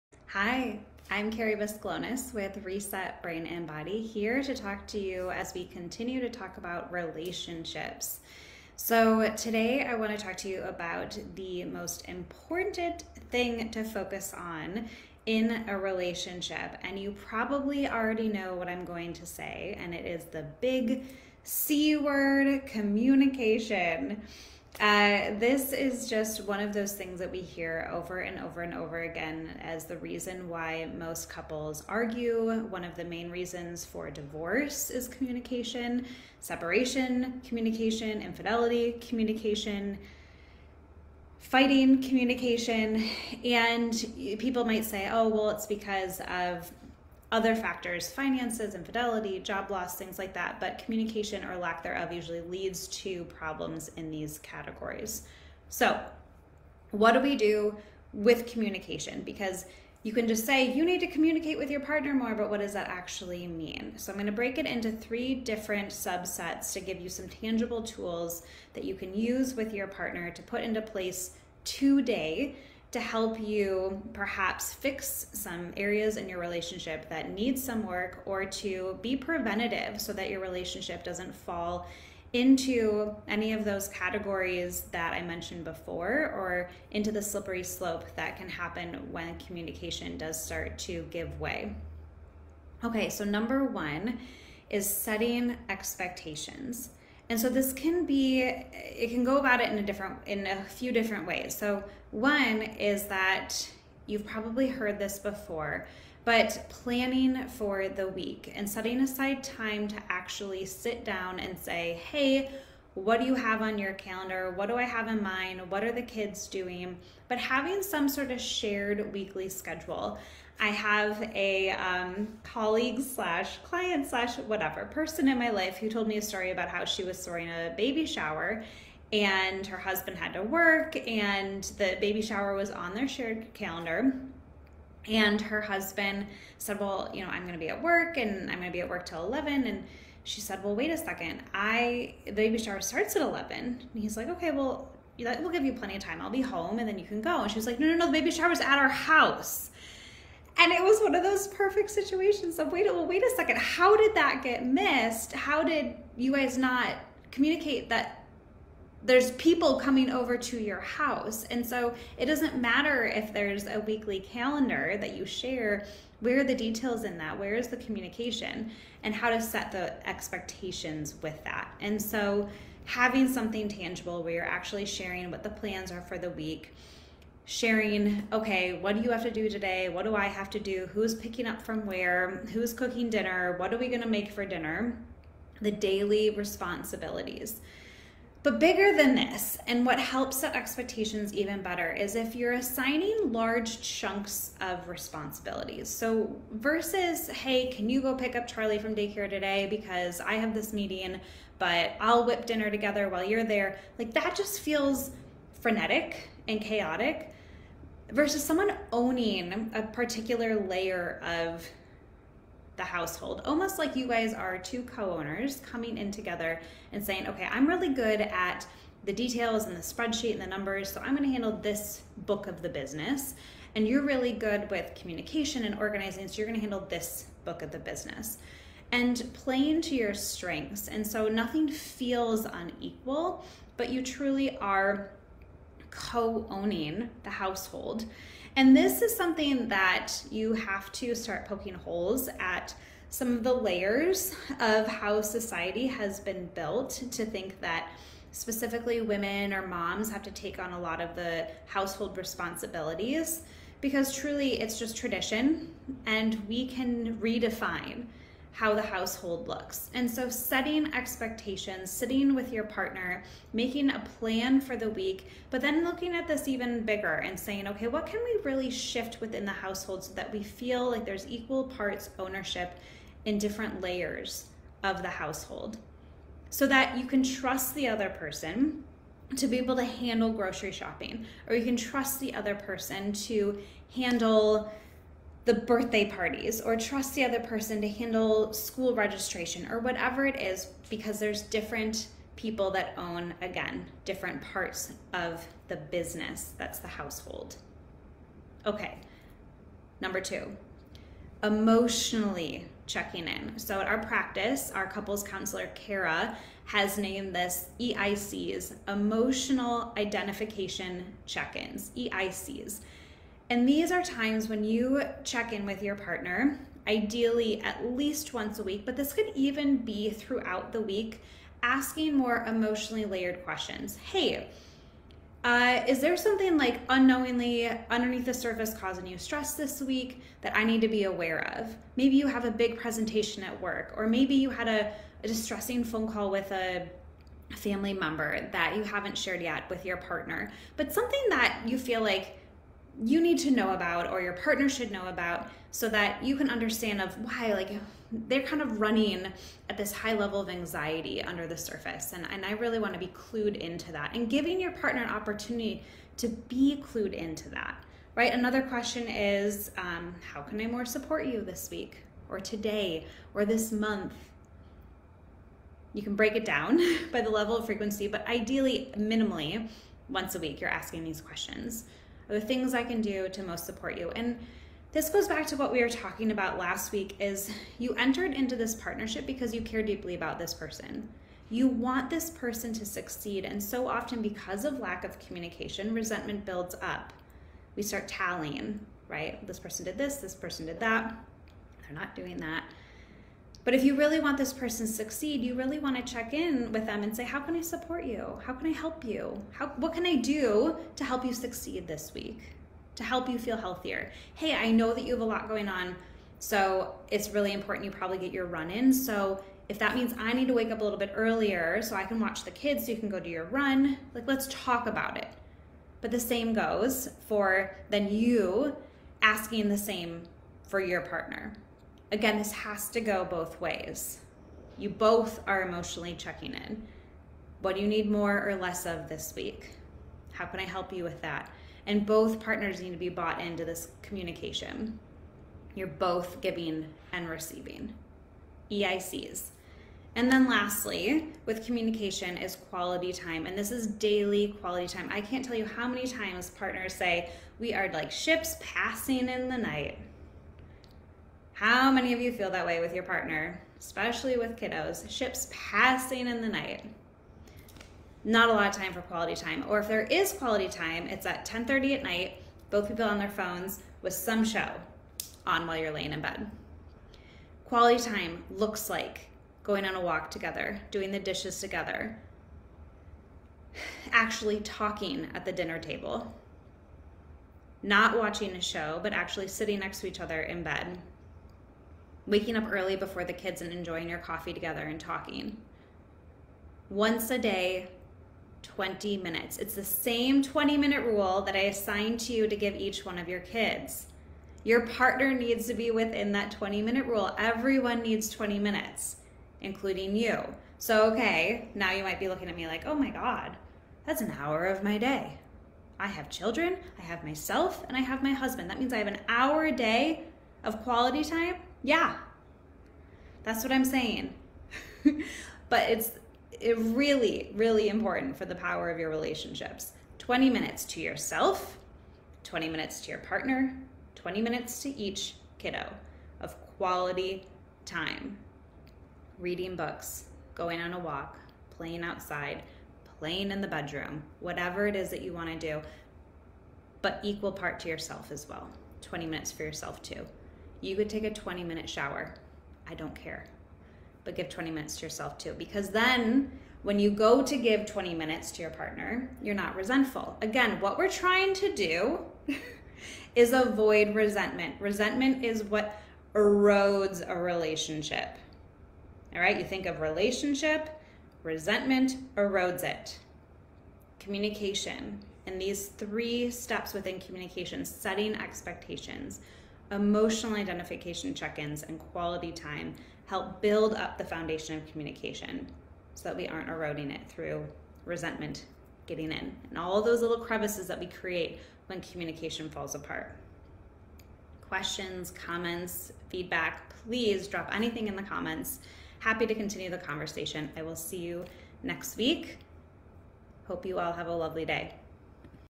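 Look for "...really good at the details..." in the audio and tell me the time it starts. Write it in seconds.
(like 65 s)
217 s.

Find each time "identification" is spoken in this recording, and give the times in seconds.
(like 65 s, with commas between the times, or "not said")
309 s, 570 s.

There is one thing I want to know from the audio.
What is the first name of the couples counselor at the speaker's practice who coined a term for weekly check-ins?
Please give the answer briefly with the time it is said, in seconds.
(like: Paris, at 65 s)
Kara, at 305 s.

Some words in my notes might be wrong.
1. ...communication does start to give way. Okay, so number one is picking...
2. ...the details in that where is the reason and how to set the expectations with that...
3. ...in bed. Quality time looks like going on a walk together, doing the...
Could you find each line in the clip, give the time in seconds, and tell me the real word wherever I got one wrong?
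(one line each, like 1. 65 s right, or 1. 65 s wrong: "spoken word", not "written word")
1. 89 s wrong: "setting", not "picking"
2. 166 s wrong: "communication", not "reason"
3. 466 s right.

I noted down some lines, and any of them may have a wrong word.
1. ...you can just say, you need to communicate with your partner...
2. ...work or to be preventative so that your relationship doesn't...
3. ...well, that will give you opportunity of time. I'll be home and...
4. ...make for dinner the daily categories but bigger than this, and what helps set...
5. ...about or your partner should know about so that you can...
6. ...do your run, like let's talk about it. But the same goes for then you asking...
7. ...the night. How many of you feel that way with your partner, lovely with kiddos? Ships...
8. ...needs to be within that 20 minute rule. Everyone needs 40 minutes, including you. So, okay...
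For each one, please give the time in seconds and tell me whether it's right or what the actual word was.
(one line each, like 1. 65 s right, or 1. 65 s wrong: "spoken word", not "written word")
1. 60 s right
2. 77 s right
3. 144 s wrong: "plenty", not "opportunity"
4. 184 s wrong: "responsibilities", not "categories"
5. 343 s right
6. 413 s right
7. 449 s wrong: "especially", not "lovely"
8. 495 s wrong: "20", not "40".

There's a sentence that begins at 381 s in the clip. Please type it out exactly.
You want this person to succeed, and so often because of lack of communication, resentment builds up.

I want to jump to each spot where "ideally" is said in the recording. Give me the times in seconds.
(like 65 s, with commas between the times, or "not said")
316 s, 368 s.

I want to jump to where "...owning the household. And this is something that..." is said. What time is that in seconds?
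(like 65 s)
236 s.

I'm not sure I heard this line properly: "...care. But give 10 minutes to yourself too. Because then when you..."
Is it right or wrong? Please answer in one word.
wrong.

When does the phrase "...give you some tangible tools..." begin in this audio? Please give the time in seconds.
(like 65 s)
66 s.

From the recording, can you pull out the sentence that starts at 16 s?
And you probably already know what I'm going to say, and it is the big C word communication.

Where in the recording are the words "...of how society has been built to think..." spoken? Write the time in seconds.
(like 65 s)
244 s.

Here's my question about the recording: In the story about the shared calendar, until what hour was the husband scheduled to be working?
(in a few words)
11.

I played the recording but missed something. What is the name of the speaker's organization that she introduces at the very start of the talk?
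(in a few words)
Reset Brain and Body.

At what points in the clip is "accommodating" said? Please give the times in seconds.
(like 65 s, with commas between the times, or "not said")
not said.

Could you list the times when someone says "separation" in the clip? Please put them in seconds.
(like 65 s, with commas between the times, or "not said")
36 s.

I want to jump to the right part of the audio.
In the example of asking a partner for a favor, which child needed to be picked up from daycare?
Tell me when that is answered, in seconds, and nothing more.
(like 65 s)
198 s.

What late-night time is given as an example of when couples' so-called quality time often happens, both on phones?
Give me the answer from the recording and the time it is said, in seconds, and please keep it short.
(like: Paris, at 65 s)
10:30, at 461 s.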